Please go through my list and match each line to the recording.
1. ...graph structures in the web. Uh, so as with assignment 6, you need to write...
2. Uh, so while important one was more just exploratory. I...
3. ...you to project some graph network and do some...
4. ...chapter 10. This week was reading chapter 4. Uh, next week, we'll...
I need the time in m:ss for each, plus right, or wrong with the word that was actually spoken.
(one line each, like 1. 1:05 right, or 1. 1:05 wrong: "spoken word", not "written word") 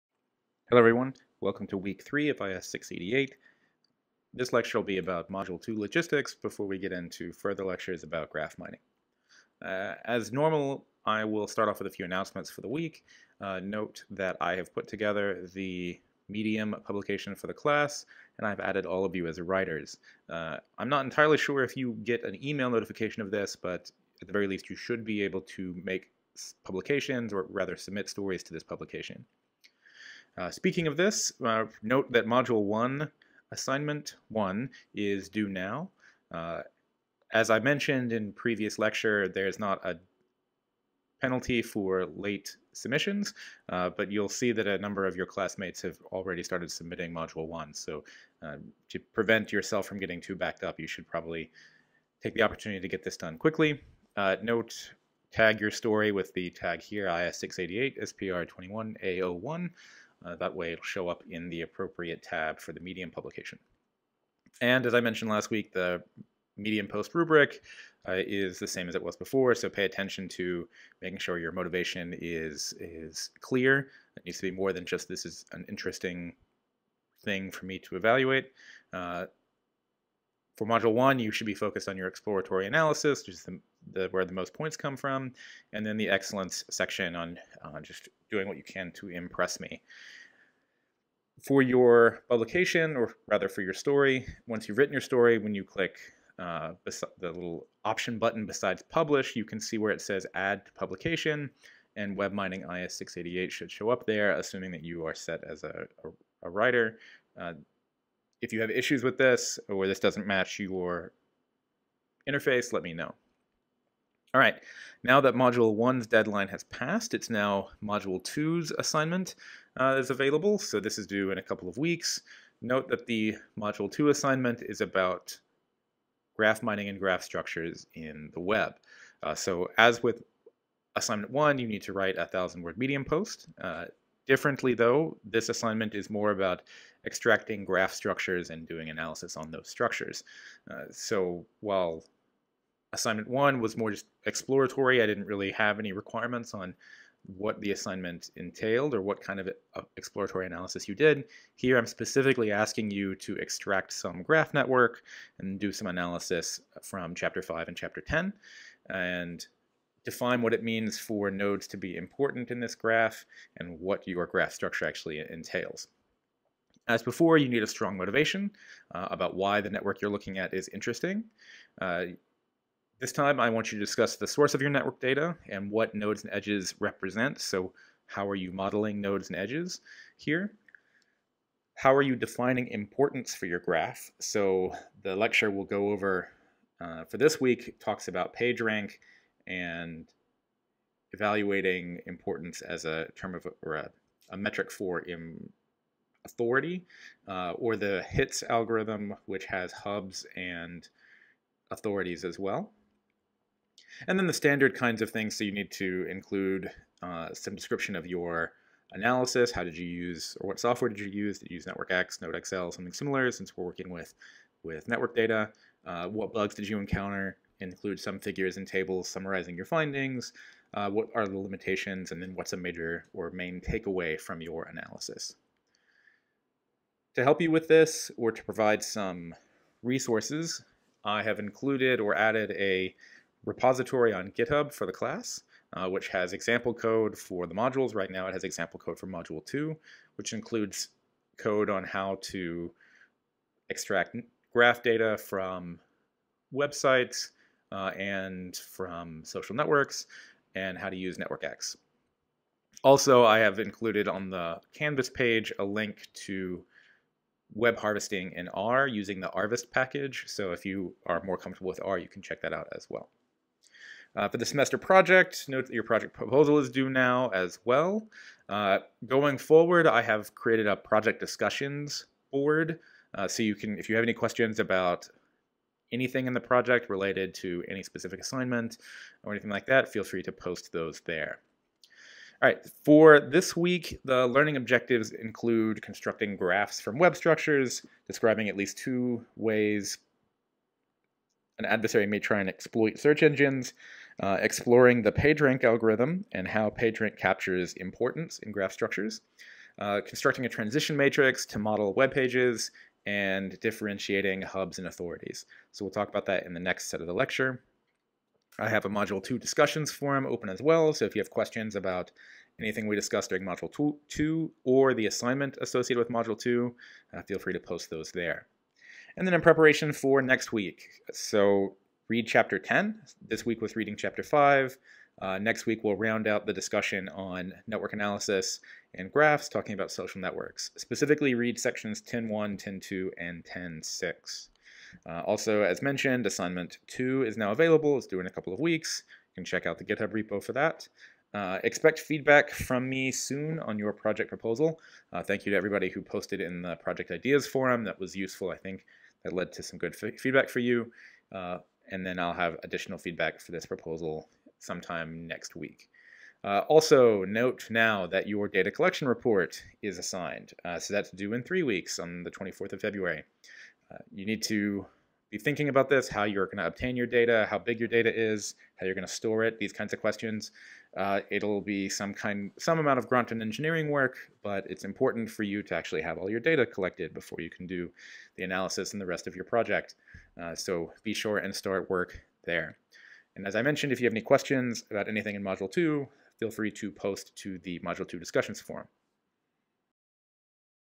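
1. 2:06 wrong: "1", not "6"
2. 2:20 wrong: "assignment", not "important"
3. 2:32 wrong: "extract", not "project"
4. 5:22 wrong: "5", not "4".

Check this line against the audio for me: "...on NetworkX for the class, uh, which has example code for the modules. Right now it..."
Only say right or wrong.
wrong.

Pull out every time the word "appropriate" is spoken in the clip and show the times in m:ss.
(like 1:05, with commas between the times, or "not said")
1:01.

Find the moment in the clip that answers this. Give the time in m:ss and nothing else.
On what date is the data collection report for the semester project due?
6:02.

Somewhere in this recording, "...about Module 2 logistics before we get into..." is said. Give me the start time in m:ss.
0:04.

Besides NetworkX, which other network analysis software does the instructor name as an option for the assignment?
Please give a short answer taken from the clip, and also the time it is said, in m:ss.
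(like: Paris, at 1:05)
NodeXL, at 3:32.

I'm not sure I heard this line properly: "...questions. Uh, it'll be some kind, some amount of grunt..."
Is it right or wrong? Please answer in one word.
right.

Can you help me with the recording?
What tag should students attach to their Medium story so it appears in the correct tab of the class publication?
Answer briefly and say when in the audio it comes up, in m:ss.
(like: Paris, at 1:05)
IS688, SPR21A01, at 0:57.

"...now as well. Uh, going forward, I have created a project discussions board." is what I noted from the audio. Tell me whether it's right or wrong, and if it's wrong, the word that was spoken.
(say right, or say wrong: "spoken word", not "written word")
right.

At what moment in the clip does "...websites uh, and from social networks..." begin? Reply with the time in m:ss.
4:06.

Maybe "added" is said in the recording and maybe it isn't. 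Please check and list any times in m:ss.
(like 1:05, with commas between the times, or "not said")
0:18, 3:52.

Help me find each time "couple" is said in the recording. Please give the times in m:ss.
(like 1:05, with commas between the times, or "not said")
2:01, 5:38.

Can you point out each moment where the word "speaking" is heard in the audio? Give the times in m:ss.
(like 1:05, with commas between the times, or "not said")
0:30.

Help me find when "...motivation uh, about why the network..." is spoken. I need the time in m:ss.
2:47.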